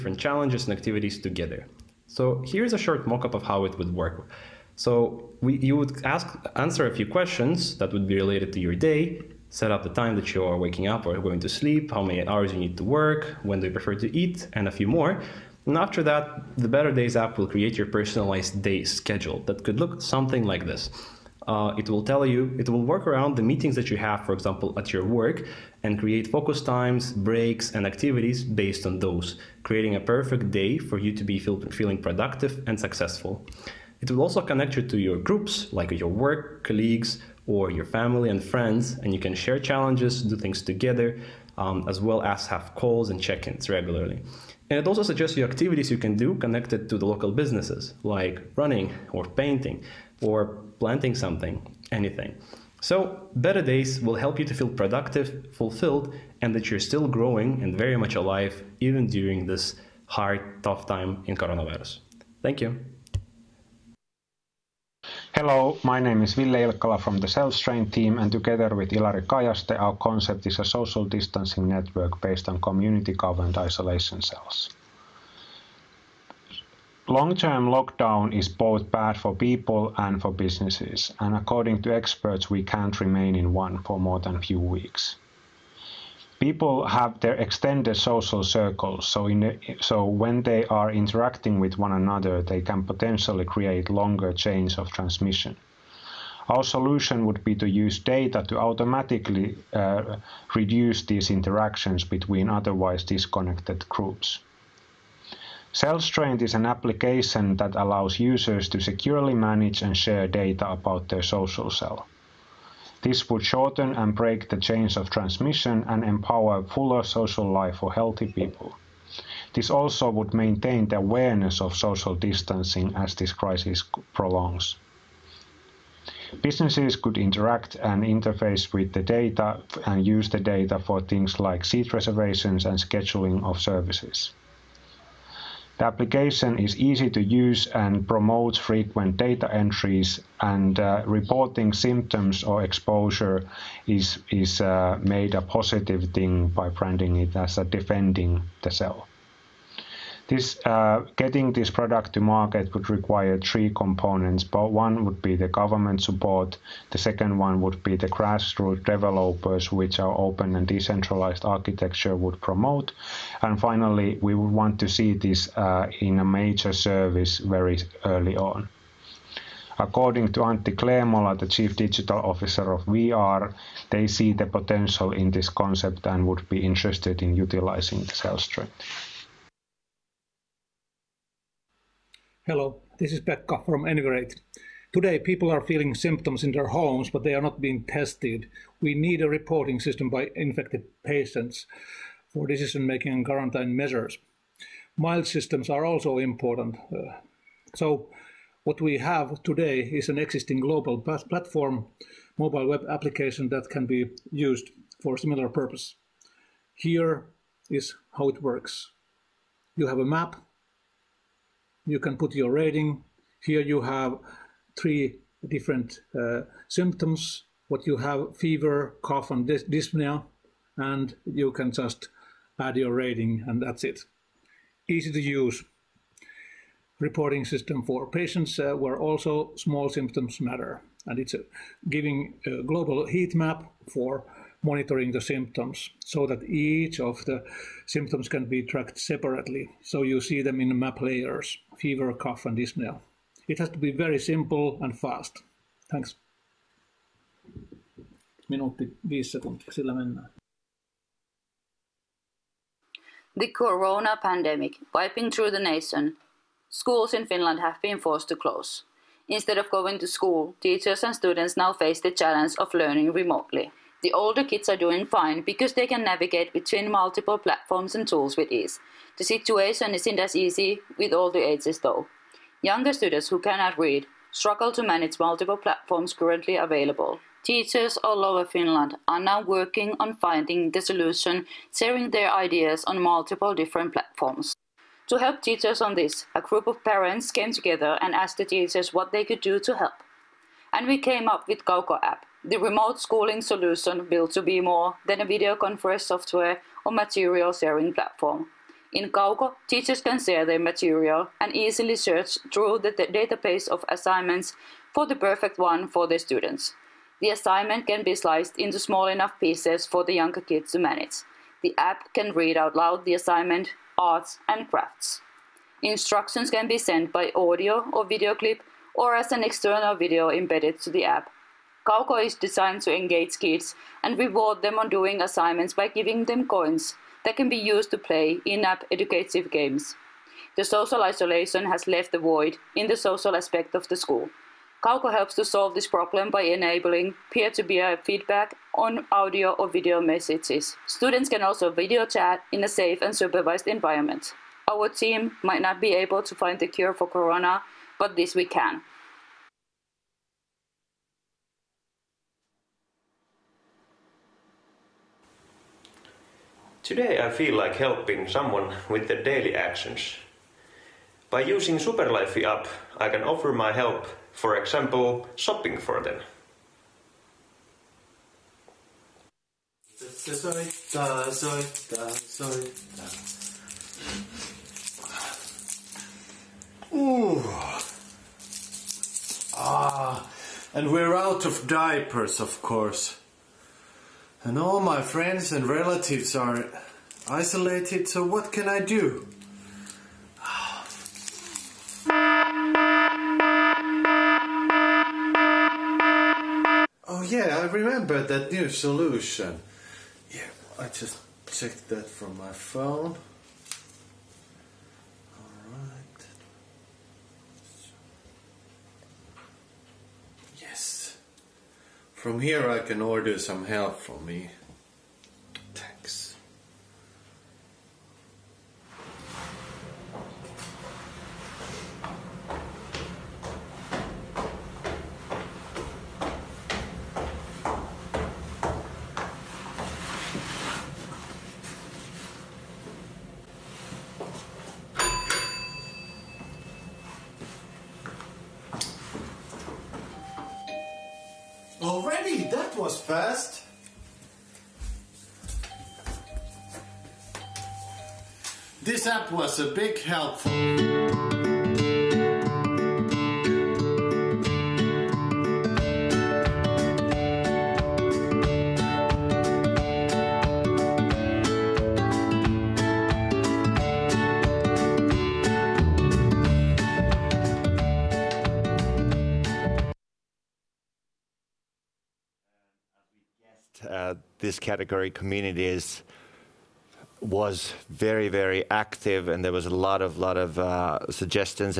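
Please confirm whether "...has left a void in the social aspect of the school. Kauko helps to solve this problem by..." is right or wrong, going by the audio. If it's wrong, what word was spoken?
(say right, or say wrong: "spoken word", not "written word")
right.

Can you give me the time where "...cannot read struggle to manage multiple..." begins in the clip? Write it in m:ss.
4:33.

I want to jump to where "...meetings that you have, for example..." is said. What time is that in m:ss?
0:23.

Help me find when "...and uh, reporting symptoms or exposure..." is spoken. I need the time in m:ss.
2:20.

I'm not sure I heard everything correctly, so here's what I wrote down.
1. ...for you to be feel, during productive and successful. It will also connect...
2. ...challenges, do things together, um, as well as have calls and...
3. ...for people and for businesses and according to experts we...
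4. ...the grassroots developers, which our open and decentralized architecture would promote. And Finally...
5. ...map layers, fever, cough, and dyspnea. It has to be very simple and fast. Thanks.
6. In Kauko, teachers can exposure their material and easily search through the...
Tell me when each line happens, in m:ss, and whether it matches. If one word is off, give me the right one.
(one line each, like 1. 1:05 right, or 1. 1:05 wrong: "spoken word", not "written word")
1. 0:30 wrong: "feeling", not "during"
2. 0:39 right
3. 1:19 right
4. 2:37 right
5. 4:00 right
6. 4:58 wrong: "share", not "exposure".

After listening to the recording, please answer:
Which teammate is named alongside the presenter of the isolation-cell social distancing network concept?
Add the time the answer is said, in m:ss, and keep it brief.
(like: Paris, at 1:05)
Ilari Kajaste, at 1:08.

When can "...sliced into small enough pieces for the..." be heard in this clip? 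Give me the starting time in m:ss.
5:08.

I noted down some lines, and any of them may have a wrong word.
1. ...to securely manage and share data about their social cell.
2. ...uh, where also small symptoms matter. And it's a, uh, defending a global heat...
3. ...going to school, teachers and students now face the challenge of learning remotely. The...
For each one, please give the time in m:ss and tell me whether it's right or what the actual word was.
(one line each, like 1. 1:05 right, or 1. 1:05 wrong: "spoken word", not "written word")
1. 1:48 right
2. 3:48 wrong: "giving", not "defending"
3. 4:19 right.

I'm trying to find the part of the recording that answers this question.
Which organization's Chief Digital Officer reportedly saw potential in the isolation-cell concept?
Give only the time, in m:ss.
2:52.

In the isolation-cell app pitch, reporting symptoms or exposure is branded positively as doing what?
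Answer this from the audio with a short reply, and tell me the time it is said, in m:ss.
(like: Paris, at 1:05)
defending the cell, at 2:27.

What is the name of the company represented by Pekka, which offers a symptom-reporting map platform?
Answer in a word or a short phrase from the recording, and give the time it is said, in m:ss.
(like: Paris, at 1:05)
Enigrate, at 3:03.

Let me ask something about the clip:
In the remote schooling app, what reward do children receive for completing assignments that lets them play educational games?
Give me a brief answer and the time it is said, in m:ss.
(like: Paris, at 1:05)
coins, at 5:26.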